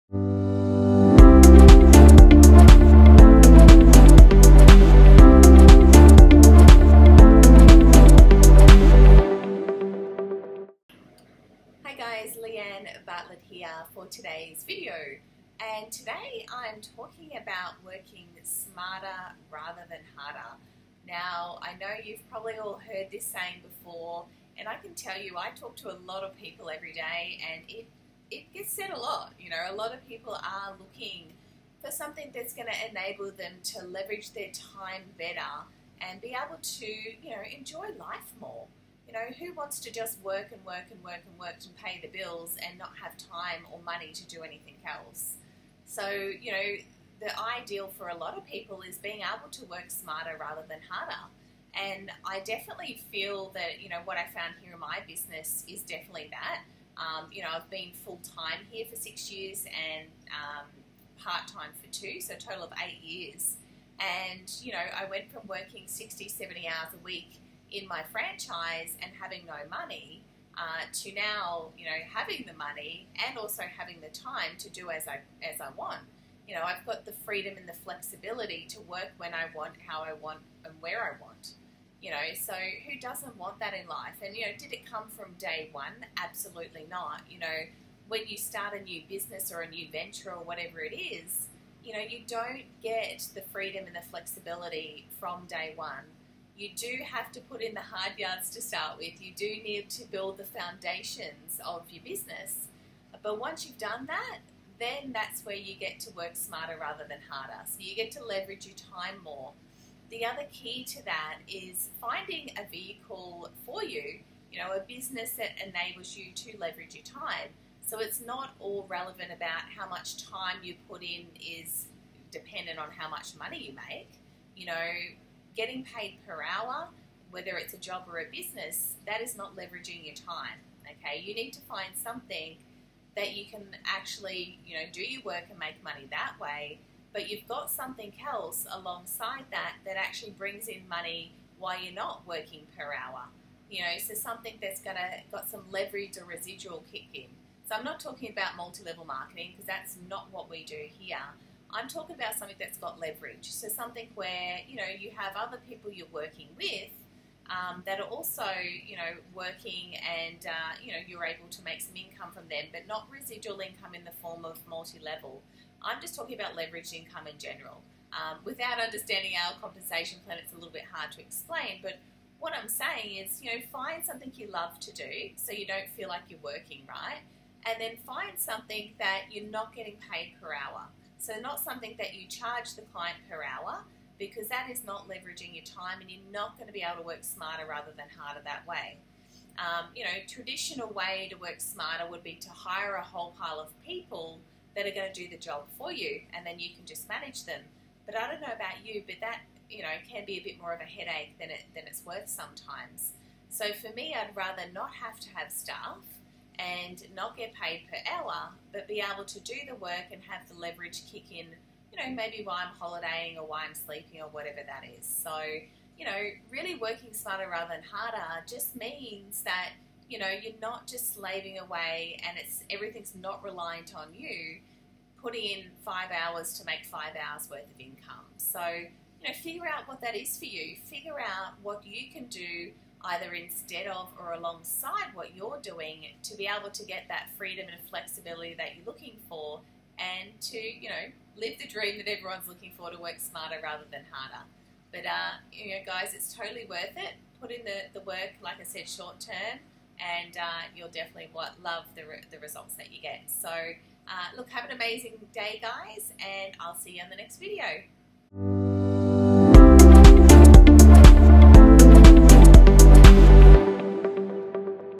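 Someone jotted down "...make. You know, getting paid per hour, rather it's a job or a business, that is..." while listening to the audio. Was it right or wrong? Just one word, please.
wrong.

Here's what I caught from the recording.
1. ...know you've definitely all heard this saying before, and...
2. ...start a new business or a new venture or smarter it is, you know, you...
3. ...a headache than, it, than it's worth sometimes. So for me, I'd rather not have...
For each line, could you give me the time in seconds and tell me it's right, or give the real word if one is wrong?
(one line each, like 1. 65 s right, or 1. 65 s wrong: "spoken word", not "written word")
1. 21 s wrong: "probably", not "definitely"
2. 88 s wrong: "whatever", not "smarter"
3. 200 s right.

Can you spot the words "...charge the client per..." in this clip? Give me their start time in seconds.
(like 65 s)
182 s.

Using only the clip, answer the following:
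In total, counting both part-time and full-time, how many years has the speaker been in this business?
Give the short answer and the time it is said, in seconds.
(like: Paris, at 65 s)
8, at 62 s.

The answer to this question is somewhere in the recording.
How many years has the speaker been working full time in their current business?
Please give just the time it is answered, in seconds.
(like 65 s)
58 s.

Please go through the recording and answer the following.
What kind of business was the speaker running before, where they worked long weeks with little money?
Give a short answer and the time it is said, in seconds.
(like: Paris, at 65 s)
franchise, at 68 s.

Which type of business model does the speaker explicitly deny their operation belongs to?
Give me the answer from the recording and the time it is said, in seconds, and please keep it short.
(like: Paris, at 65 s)
multi-level marketing, at 148 s.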